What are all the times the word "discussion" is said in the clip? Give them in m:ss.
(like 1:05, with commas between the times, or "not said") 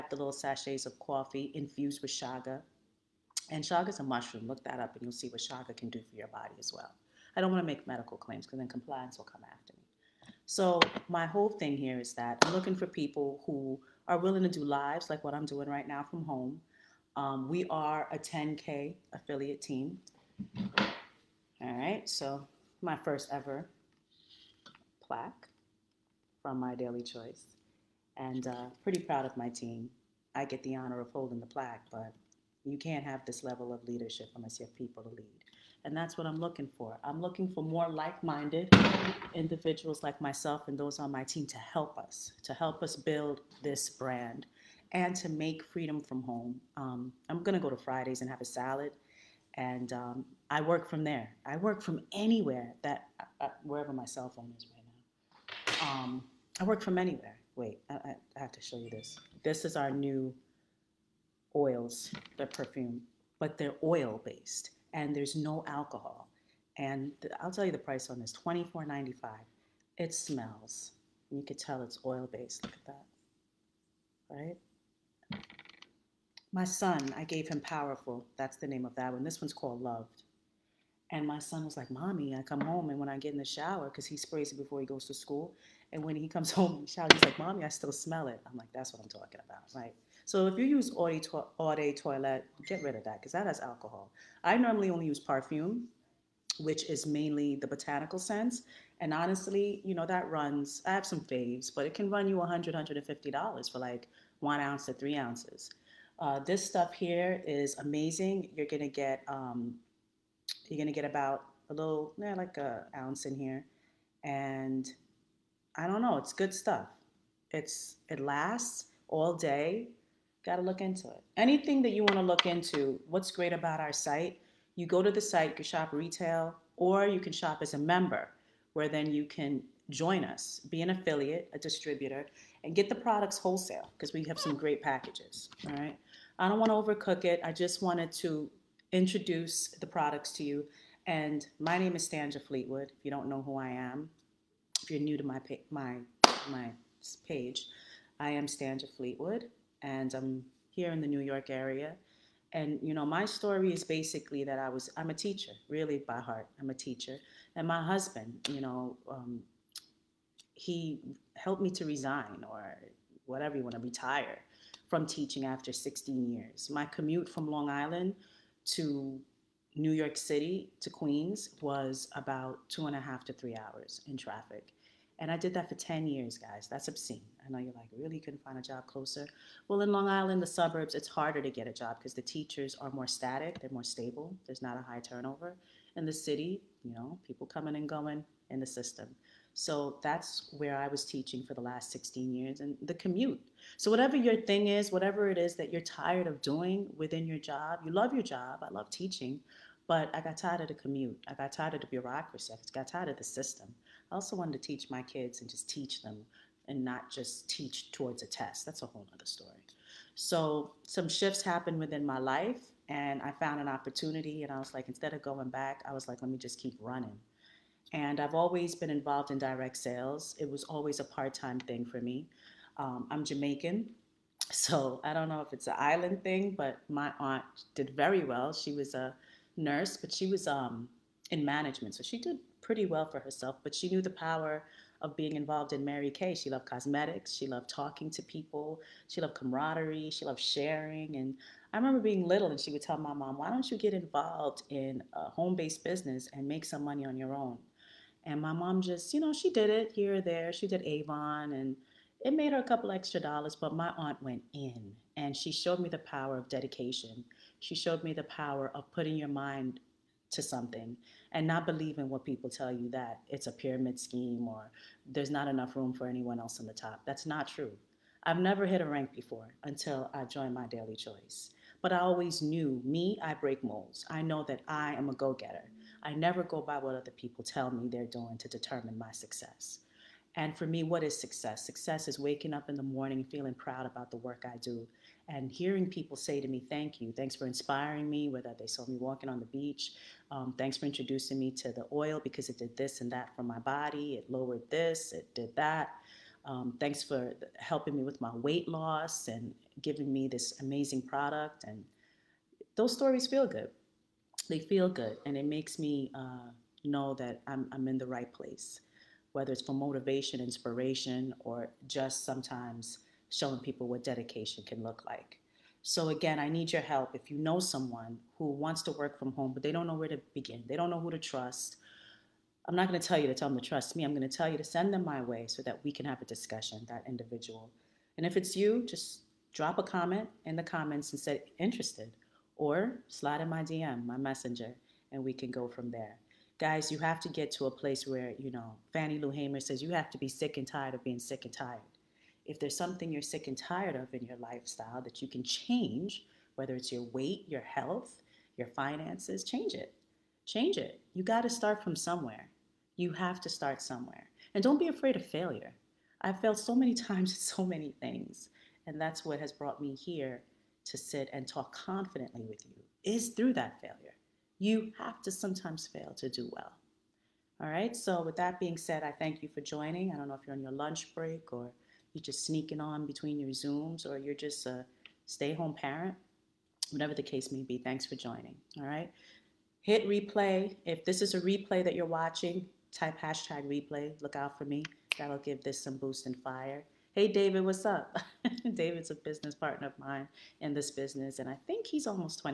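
5:26.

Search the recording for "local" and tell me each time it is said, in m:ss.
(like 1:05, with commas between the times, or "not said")
not said.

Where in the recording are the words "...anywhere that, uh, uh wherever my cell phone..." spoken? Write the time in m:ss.
0:52.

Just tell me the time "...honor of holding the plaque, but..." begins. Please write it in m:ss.
0:30.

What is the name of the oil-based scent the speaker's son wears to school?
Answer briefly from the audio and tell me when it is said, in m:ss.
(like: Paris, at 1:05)
Powerful, at 1:17.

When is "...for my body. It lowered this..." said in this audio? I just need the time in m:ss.
4:53.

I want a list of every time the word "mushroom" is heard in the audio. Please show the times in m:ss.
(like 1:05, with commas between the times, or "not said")
0:04.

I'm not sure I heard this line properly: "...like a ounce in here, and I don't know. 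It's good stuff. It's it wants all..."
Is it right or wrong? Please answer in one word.
wrong.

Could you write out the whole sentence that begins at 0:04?
Look that up and you'll see what chaga can do for your body as well.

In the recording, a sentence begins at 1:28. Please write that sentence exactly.
I'm like, That's what I'm talking about, right?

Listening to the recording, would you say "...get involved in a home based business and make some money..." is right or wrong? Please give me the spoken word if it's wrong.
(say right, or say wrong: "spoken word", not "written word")
right.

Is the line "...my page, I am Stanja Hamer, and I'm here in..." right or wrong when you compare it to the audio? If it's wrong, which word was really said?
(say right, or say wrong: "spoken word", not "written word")
wrong: "Fleetwood", not "Hamer".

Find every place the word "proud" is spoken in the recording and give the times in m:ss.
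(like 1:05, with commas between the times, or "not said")
0:28, 4:43.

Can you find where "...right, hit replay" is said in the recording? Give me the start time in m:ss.
6:18.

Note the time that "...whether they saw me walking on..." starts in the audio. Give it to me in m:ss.
4:48.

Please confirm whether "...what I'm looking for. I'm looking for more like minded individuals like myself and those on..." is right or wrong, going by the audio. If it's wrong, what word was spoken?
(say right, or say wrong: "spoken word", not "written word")
right.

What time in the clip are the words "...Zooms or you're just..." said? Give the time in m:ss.
6:13.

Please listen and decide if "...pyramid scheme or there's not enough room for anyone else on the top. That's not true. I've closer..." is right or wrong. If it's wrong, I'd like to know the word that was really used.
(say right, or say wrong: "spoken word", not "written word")
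wrong: "never", not "closer".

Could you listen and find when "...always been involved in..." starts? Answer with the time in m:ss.
3:38.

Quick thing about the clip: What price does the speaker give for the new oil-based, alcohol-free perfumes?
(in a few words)
$24.95.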